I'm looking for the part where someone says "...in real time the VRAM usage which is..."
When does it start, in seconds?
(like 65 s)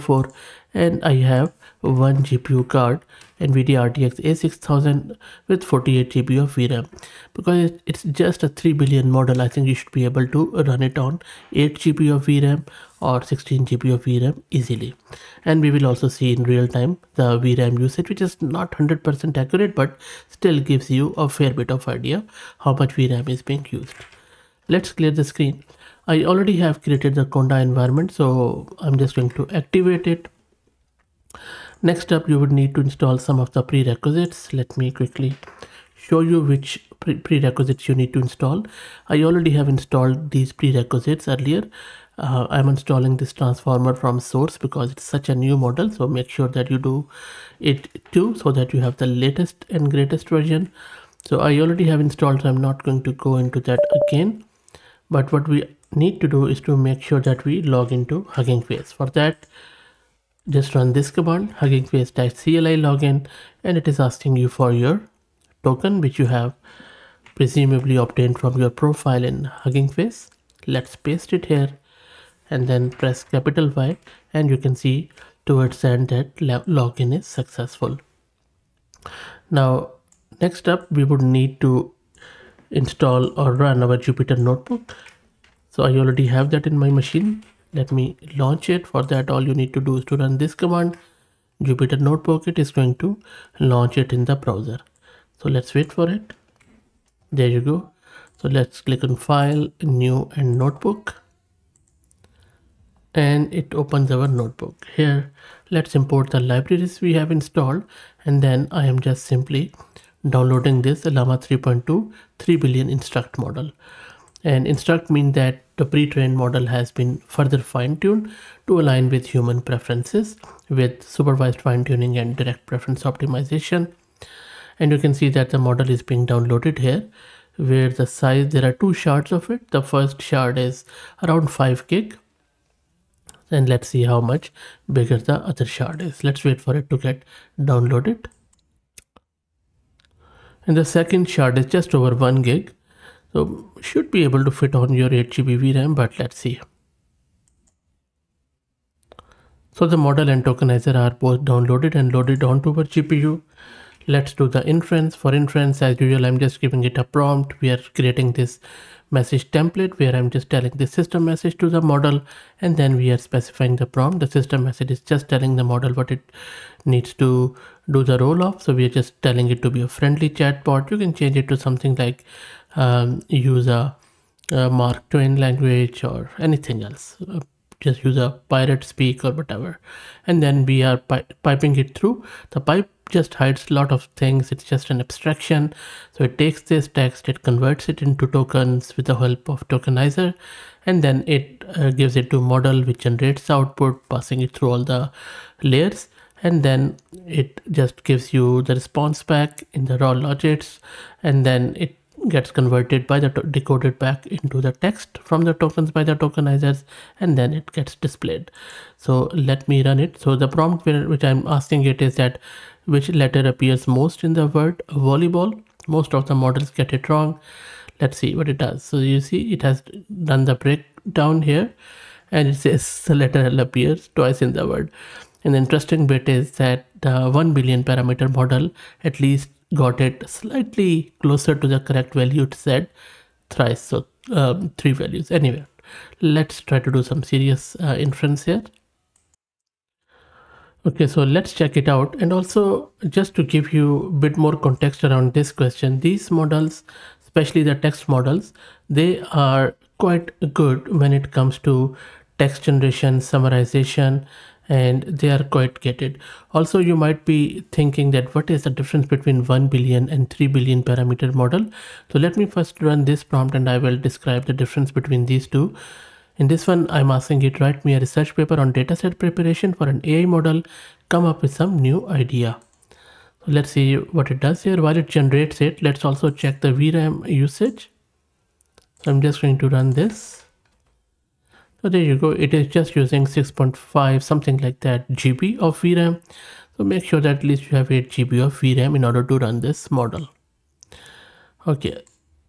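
16 s.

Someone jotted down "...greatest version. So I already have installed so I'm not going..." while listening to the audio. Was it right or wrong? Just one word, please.
right.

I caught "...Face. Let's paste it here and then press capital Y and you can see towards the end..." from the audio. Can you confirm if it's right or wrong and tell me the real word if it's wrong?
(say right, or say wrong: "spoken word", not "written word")
right.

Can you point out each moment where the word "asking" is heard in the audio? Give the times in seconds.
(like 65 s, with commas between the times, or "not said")
63 s, 211 s, 267 s.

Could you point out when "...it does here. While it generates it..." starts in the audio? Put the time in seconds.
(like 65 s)
274 s.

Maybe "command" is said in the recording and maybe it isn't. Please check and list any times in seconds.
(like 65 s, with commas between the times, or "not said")
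61 s, 90 s.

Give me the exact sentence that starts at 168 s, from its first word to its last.
So we are just telling it to be a friendly chatbot.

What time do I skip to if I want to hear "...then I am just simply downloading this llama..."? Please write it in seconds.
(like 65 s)
108 s.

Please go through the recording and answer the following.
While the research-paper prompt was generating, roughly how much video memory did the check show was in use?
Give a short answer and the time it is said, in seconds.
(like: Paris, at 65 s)
6.5 GB, at 283 s.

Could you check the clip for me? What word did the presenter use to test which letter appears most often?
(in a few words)
volleyball.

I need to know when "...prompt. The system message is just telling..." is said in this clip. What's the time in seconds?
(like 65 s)
163 s.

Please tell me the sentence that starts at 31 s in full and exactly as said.
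Next up you would need to install some of the prerequisites.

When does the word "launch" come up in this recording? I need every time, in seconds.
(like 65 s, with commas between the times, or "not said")
88 s, 93 s.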